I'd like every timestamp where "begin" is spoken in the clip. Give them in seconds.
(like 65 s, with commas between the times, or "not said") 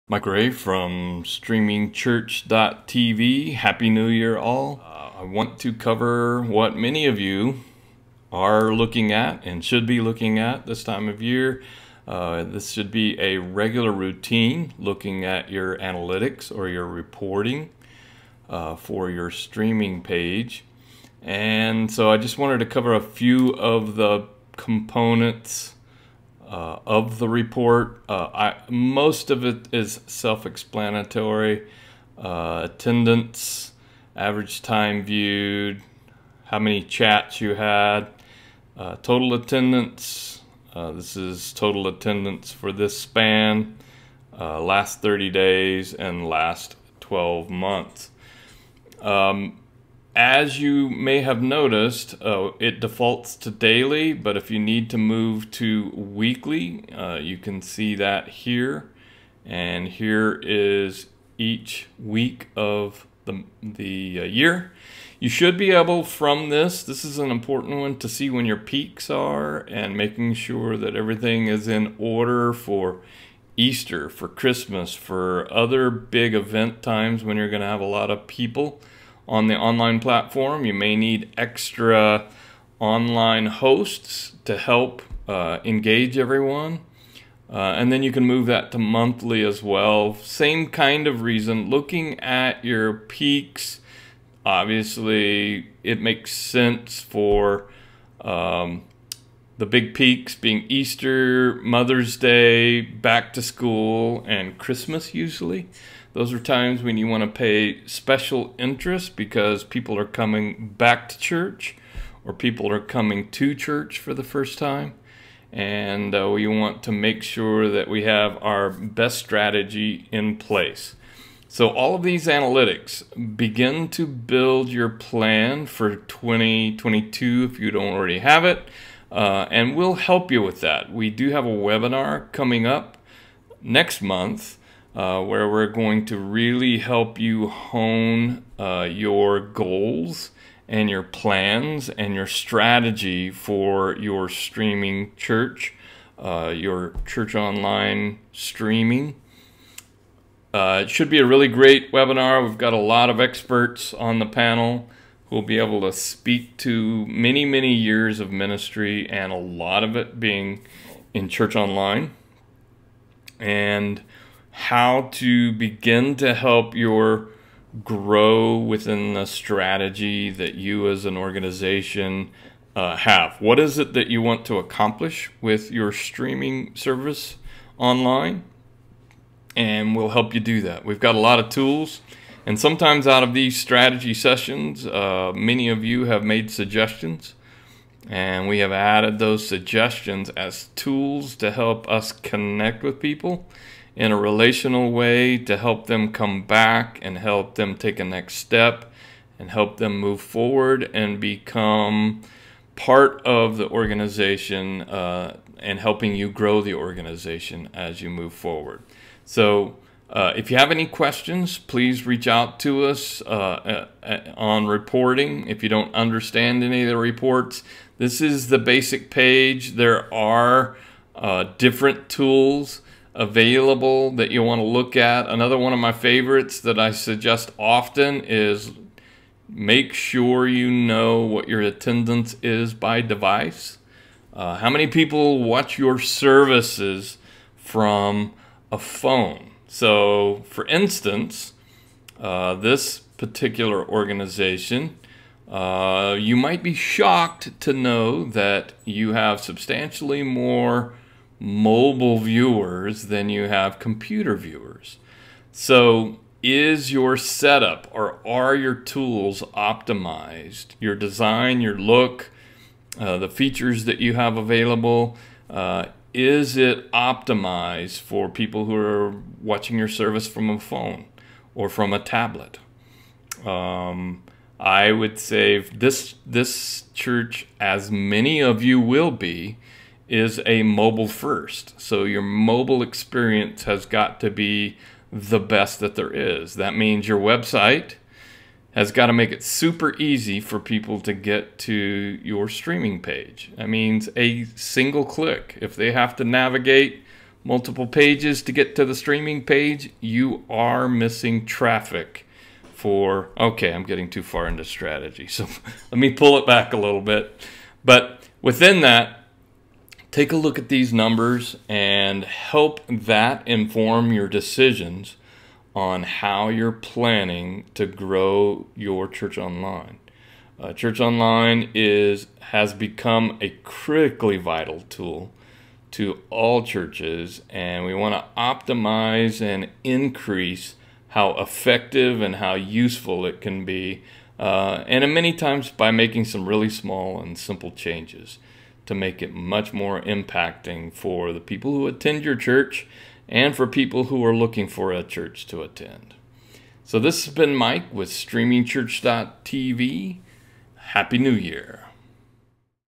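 123 s, 165 s.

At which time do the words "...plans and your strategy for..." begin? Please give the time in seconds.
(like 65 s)
141 s.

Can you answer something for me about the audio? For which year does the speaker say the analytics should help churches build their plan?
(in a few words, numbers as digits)
2022.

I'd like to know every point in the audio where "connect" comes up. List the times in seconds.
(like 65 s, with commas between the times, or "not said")
192 s.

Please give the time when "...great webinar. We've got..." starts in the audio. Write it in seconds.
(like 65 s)
151 s.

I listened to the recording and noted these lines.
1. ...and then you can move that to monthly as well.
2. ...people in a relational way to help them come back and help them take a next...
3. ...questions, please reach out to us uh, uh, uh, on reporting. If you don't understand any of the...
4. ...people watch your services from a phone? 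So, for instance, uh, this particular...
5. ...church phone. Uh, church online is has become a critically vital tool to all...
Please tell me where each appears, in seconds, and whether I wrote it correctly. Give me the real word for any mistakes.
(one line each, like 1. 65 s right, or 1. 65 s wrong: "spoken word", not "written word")
1. 87 s right
2. 192 s right
3. 210 s right
4. 234 s right
5. 319 s wrong: "online", not "phone".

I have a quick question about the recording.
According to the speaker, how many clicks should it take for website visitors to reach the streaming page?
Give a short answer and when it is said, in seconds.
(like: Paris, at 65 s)
1, at 294 s.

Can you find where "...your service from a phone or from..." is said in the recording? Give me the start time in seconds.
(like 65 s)
269 s.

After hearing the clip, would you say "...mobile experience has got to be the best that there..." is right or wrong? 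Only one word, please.
right.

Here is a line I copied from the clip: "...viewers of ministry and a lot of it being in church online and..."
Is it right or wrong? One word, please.
wrong.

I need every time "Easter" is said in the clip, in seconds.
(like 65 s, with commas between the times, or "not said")
73 s, 100 s.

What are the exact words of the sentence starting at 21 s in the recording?
And so I just wanted to cover a few of the components uh, of the report.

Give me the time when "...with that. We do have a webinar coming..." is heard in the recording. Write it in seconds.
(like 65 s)
130 s.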